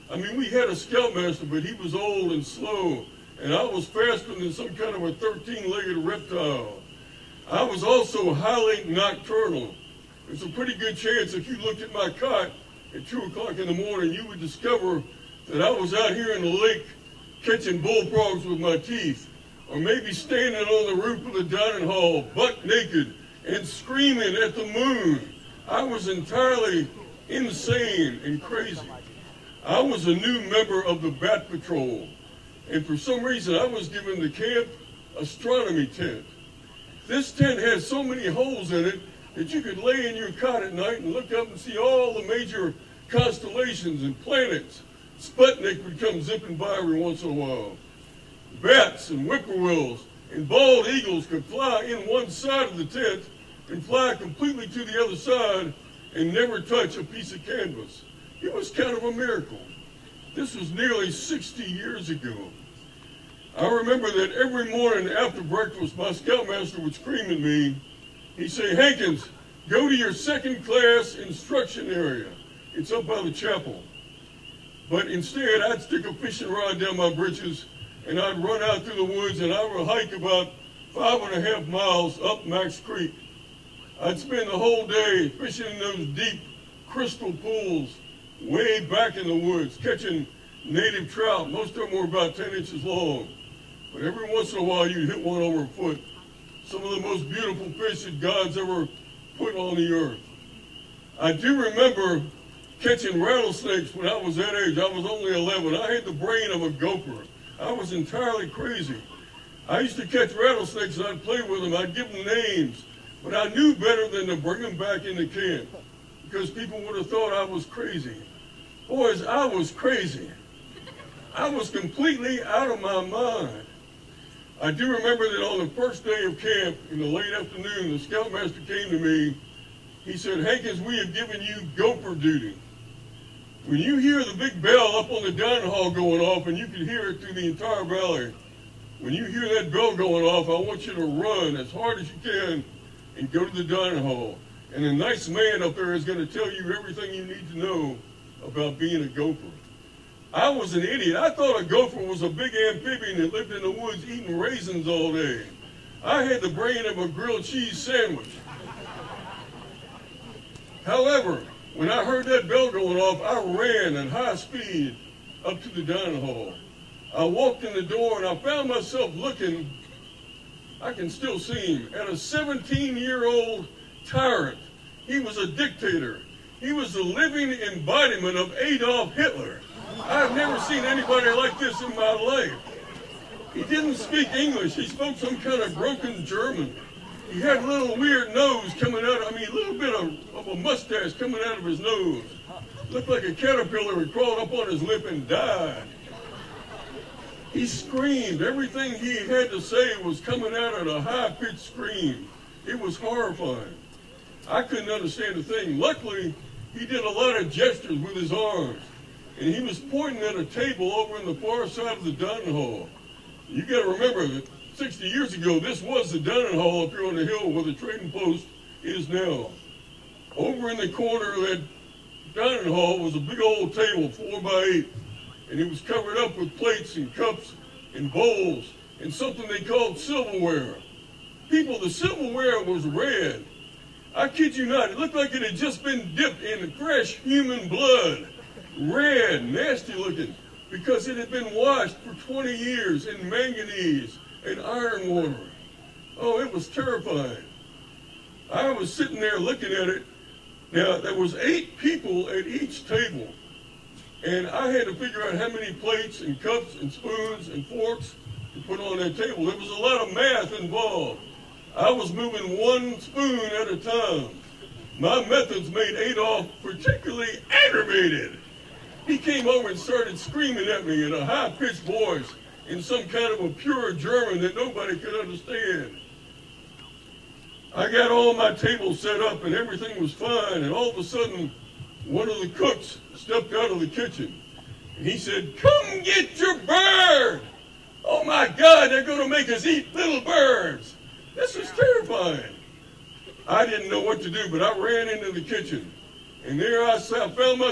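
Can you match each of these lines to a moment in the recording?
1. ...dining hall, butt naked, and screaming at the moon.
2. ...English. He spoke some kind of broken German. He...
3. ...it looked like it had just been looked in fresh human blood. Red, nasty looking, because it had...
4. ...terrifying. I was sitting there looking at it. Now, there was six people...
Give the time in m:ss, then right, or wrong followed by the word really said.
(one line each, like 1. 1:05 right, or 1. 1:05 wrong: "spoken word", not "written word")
1. 0:21 right
2. 3:04 right
3. 3:54 wrong: "dipped", not "looked"
4. 4:06 wrong: "eight", not "six".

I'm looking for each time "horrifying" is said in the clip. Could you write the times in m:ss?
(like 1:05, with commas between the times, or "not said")
3:22.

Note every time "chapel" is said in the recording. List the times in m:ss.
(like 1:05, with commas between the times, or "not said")
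1:13.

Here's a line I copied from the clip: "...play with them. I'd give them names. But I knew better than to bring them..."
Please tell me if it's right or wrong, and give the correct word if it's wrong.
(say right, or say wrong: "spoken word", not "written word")
right.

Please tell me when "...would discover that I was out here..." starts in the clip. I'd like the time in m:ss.
0:14.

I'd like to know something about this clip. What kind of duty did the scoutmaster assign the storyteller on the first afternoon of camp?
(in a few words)
gopher duty.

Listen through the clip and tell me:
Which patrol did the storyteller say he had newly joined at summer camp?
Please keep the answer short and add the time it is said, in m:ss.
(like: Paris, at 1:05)
Bat Patrol, at 0:31.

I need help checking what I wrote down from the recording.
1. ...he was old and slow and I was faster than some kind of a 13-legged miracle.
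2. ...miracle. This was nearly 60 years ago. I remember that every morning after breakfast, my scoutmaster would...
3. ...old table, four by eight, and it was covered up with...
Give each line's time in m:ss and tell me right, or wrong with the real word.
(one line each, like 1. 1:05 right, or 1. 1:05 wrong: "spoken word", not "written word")
1. 0:01 wrong: "reptile", not "miracle"
2. 0:59 right
3. 3:43 right.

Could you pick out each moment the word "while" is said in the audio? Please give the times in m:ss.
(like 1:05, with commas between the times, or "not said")
0:47, 1:34.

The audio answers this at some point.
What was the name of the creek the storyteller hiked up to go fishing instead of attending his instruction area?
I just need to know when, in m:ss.
1:22.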